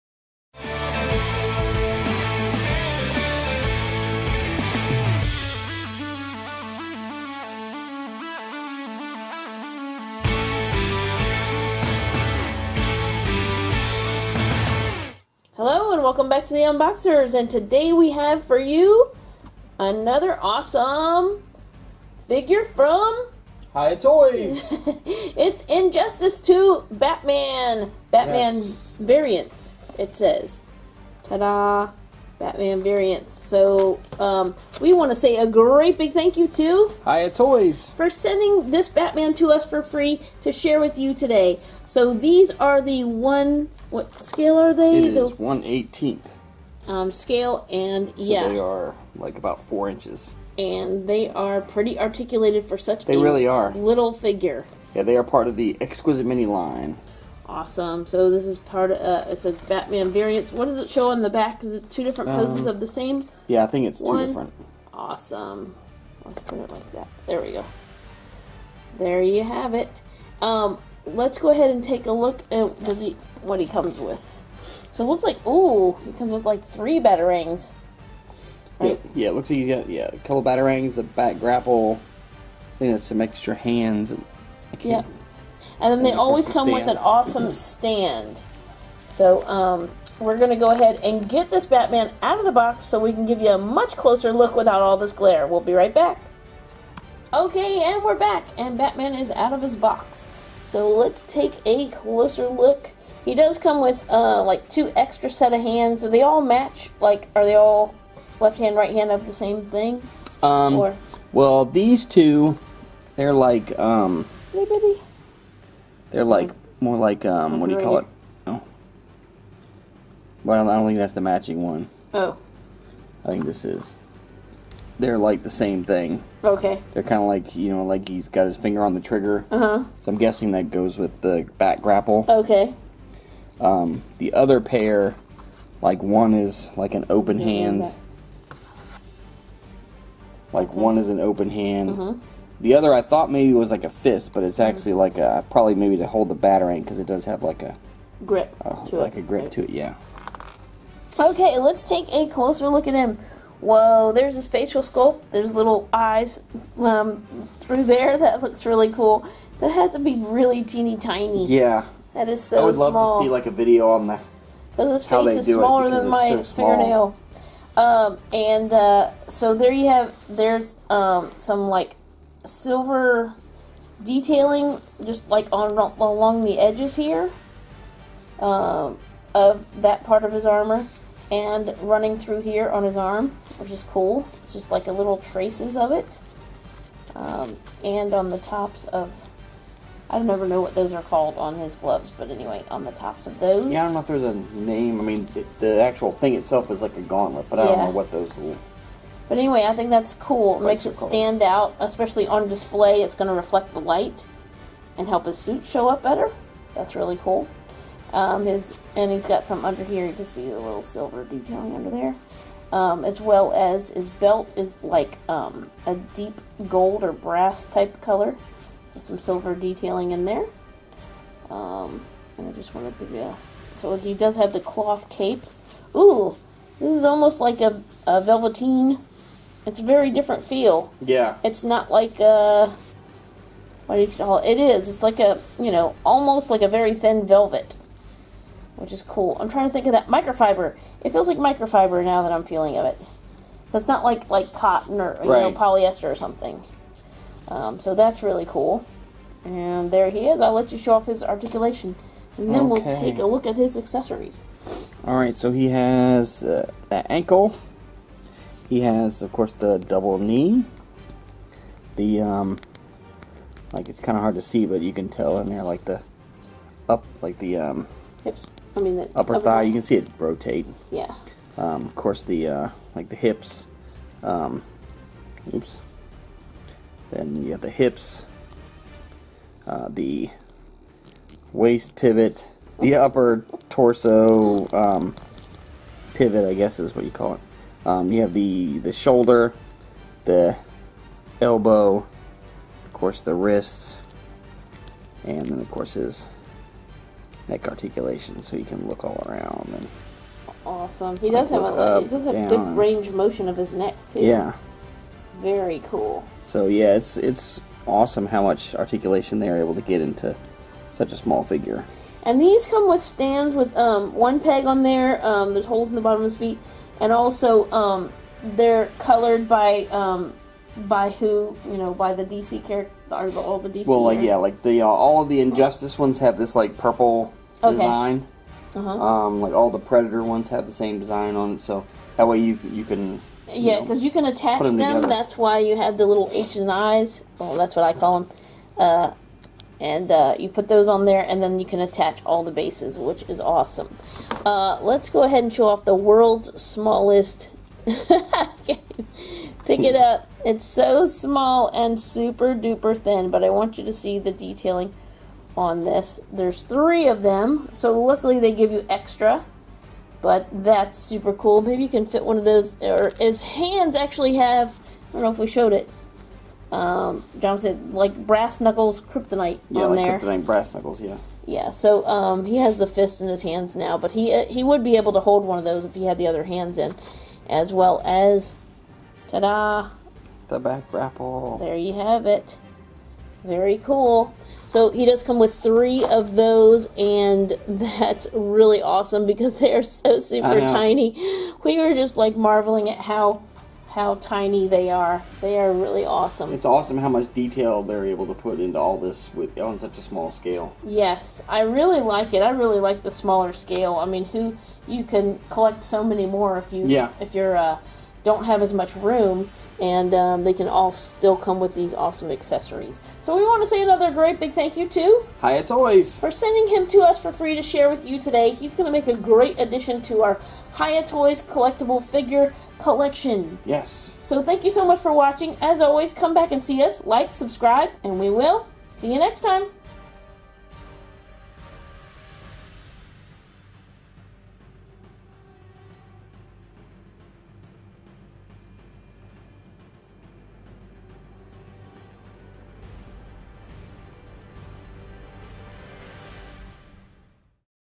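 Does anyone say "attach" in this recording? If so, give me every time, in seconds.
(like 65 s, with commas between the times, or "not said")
334 s, 341 s.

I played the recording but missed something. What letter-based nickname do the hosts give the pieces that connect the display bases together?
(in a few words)
H and I's.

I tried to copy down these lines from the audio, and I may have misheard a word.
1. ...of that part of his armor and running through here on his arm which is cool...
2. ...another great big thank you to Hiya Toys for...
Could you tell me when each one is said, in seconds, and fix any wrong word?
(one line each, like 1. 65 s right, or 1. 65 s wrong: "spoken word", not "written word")
1. 179 s right
2. 413 s right.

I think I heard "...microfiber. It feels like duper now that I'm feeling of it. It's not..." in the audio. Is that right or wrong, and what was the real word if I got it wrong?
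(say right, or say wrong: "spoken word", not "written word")
wrong: "microfiber", not "duper".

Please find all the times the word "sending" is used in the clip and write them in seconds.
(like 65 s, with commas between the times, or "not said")
38 s, 416 s.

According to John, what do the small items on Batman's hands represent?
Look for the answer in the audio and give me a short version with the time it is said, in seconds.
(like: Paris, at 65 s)
kryptonite brass knuckles, at 370 s.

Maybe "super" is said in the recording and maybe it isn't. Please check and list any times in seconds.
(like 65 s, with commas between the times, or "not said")
351 s, 360 s, 390 s.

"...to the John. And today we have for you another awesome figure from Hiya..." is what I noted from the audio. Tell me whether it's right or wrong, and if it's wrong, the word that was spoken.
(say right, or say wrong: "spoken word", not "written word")
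wrong: "Unboxers", not "John".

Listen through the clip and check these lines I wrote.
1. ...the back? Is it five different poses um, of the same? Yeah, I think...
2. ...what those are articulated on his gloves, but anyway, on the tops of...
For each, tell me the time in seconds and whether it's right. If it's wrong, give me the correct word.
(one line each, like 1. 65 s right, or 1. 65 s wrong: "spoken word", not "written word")
1. 61 s wrong: "two", not "five"
2. 190 s wrong: "called", not "articulated".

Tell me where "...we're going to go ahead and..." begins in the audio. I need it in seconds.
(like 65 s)
90 s.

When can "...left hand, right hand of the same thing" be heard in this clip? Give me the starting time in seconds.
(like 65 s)
108 s.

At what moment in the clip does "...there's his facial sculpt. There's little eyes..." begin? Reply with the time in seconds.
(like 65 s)
154 s.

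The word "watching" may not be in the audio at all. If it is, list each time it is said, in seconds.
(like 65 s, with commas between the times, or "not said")
425 s.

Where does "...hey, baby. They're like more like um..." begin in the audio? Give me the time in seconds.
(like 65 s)
114 s.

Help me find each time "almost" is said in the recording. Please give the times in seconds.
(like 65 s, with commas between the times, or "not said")
227 s, 236 s.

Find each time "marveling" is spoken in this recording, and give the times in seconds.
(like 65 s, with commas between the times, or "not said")
392 s.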